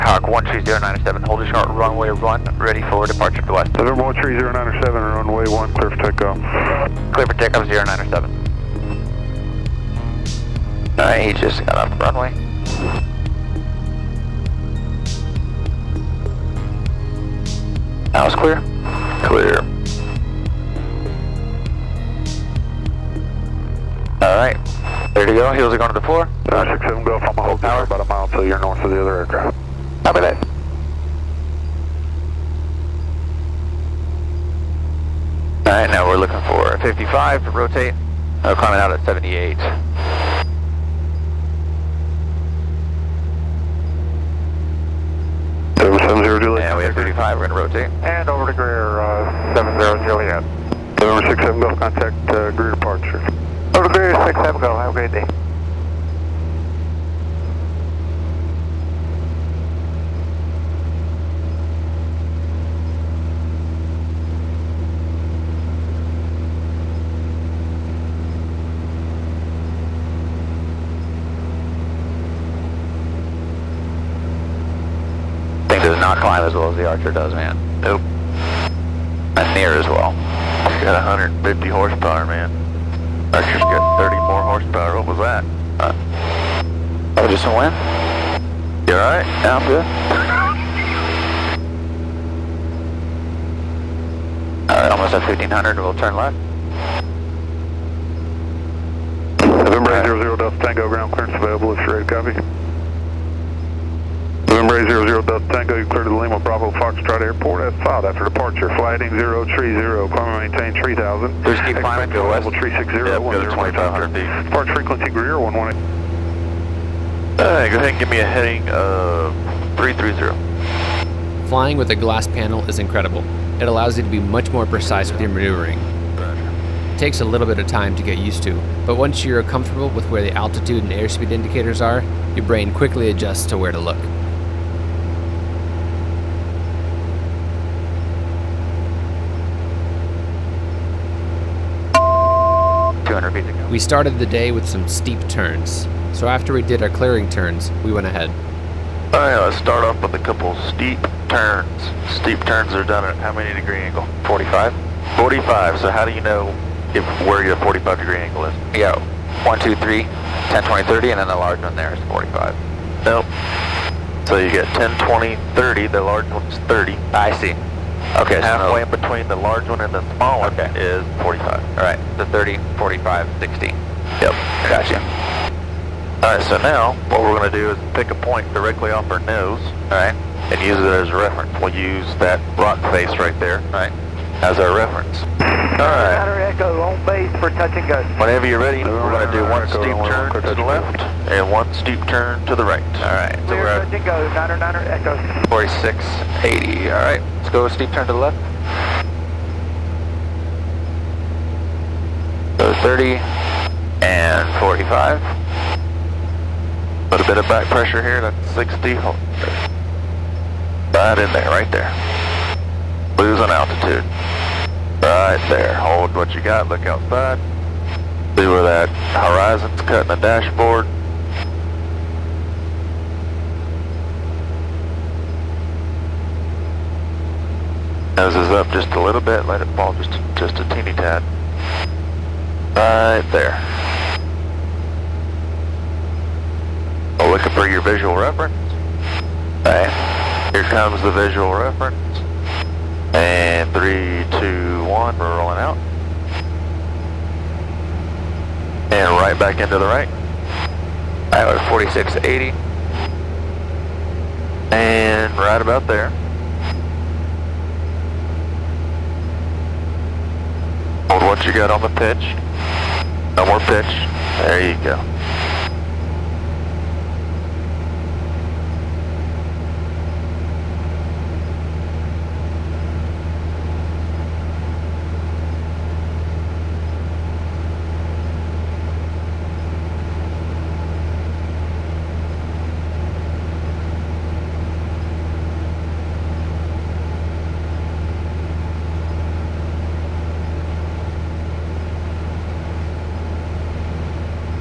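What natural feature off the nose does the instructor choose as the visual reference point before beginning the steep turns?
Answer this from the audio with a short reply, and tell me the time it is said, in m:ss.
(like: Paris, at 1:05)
rock face, at 3:02.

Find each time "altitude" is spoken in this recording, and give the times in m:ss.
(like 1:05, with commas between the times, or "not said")
2:10, 3:33.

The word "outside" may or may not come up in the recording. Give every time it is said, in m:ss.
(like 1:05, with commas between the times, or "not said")
3:36.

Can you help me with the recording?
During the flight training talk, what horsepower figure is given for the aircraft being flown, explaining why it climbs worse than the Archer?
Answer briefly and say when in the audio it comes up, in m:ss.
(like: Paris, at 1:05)
150, at 1:21.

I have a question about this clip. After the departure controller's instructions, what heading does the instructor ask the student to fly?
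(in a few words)
330.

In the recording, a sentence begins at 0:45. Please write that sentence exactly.
Yeah, we have 35, we're going to rotate.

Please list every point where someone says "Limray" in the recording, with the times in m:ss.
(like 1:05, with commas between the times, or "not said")
1:44.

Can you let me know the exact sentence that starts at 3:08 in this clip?
Whenever you're ready, we're going to do one steep turn to the left and one steep turn to the right.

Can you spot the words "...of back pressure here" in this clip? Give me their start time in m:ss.
3:27.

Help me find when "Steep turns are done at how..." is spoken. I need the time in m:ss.
2:32.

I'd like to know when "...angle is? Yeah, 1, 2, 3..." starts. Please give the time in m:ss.
2:38.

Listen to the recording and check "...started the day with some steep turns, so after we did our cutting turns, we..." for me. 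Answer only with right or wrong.
wrong.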